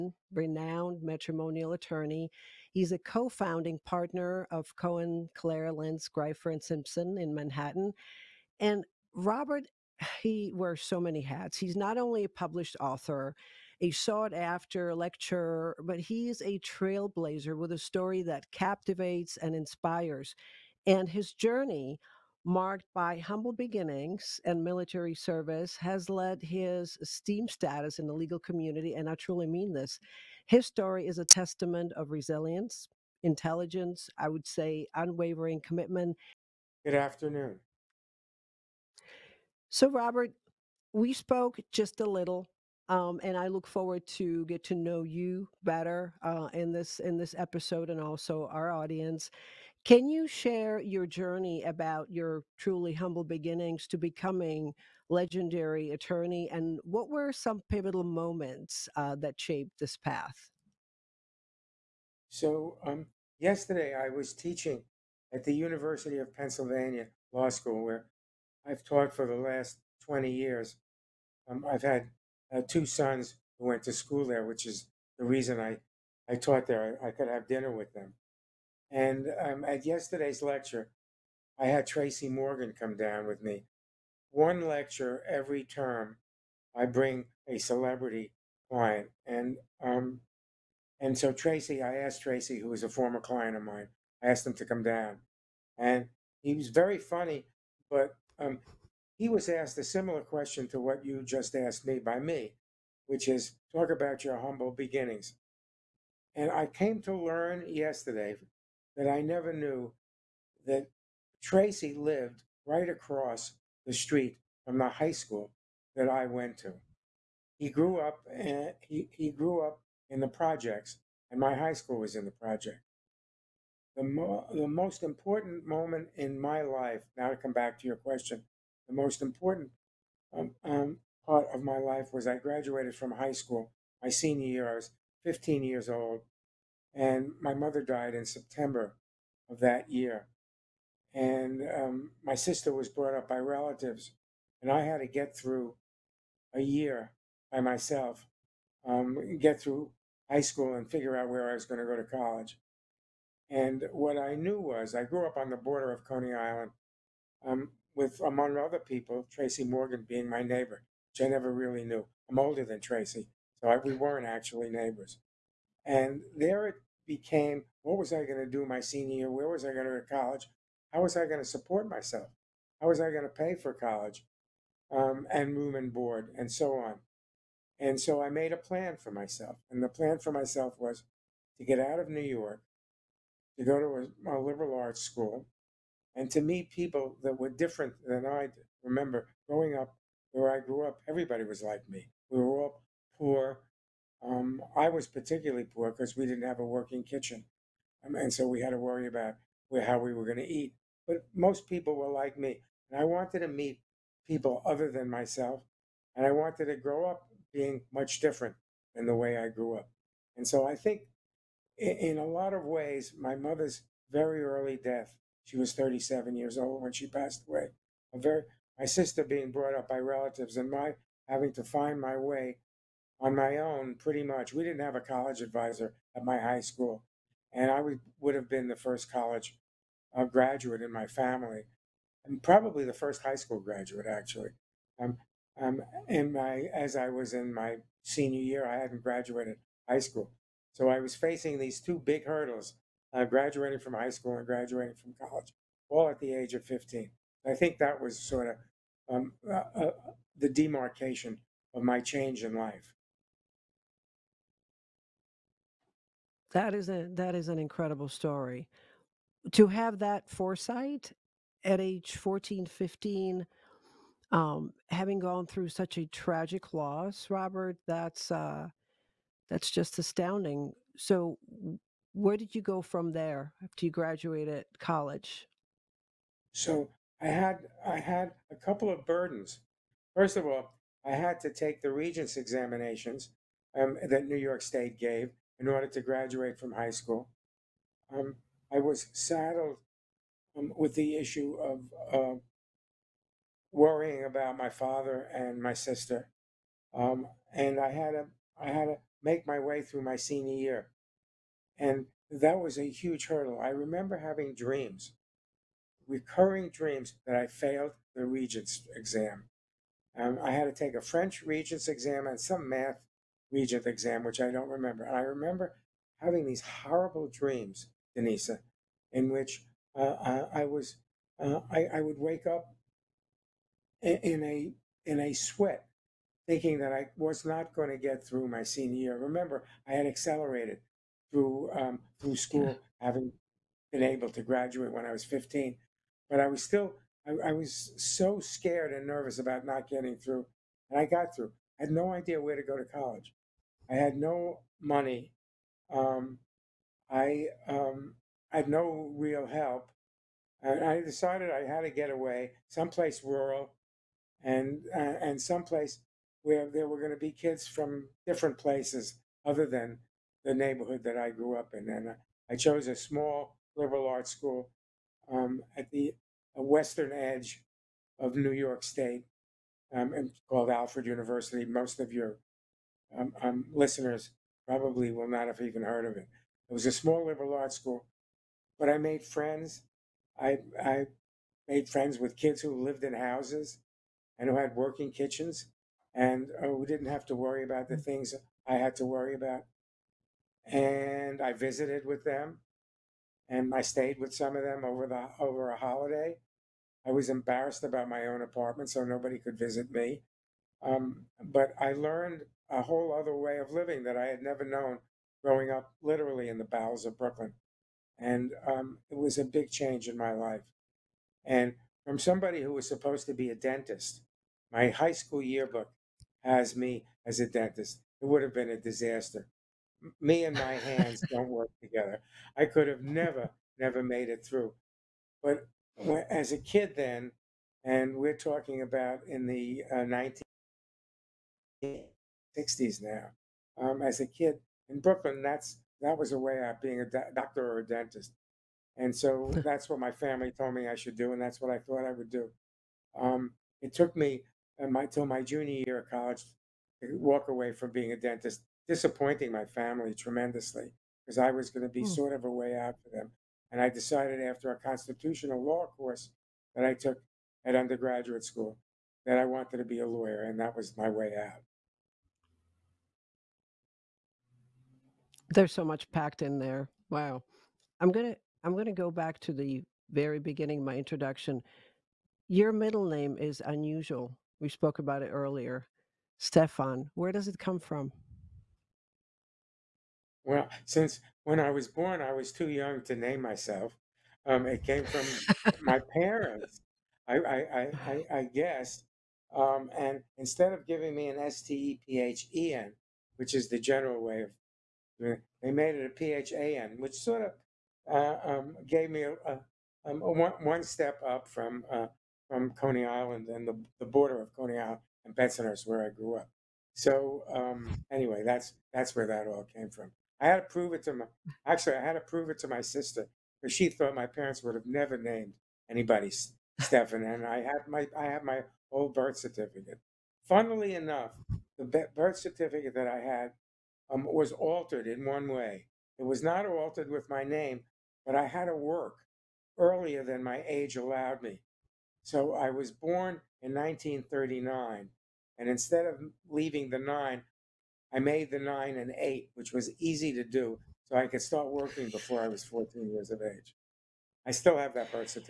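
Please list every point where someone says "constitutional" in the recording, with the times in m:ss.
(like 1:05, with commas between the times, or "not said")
7:34.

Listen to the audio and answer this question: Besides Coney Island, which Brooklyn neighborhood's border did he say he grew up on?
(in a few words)
Bensonhurst.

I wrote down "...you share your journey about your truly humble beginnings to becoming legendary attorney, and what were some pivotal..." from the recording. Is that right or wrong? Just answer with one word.
right.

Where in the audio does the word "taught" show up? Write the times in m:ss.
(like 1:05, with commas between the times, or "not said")
1:08, 1:16.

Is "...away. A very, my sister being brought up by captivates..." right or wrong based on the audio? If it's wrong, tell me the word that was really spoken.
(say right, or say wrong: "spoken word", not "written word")
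wrong: "relatives", not "captivates".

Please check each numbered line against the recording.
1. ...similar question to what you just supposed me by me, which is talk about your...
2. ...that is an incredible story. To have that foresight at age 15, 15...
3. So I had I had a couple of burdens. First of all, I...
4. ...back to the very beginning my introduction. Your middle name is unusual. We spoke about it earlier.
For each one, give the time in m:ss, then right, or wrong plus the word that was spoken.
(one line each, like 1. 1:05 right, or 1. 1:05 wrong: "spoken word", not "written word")
1. 1:39 wrong: "asked", not "supposed"
2. 4:17 wrong: "14", not "15"
3. 4:36 right
4. 7:49 right.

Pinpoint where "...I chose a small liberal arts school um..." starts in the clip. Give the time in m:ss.
6:02.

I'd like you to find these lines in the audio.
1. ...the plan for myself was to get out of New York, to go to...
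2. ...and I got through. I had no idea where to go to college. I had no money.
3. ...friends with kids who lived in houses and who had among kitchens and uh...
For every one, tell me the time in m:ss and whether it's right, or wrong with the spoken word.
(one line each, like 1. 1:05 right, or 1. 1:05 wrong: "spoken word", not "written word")
1. 2:59 right
2. 5:40 right
3. 6:21 wrong: "working", not "among".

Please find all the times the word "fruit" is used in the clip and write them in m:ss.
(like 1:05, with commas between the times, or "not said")
not said.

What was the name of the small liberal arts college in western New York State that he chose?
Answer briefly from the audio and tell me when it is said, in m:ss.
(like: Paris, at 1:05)
Alfred University, at 6:10.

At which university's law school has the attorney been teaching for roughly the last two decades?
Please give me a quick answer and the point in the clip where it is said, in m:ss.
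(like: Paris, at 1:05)
University of Pennsylvania, at 1:05.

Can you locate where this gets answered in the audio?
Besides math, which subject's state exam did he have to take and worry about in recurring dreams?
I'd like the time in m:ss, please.
5:11.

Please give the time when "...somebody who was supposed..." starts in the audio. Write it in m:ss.
6:52.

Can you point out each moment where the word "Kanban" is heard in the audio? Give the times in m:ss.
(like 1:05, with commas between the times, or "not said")
not said.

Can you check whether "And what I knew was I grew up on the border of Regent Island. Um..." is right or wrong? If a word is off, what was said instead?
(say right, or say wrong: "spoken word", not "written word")
wrong: "Coney", not "Regent".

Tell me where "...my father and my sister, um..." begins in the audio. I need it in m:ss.
4:54.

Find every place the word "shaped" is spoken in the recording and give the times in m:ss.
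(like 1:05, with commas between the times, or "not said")
0:59.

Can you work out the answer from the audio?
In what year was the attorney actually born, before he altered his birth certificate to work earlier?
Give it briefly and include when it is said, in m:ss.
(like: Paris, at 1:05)
1939, at 8:53.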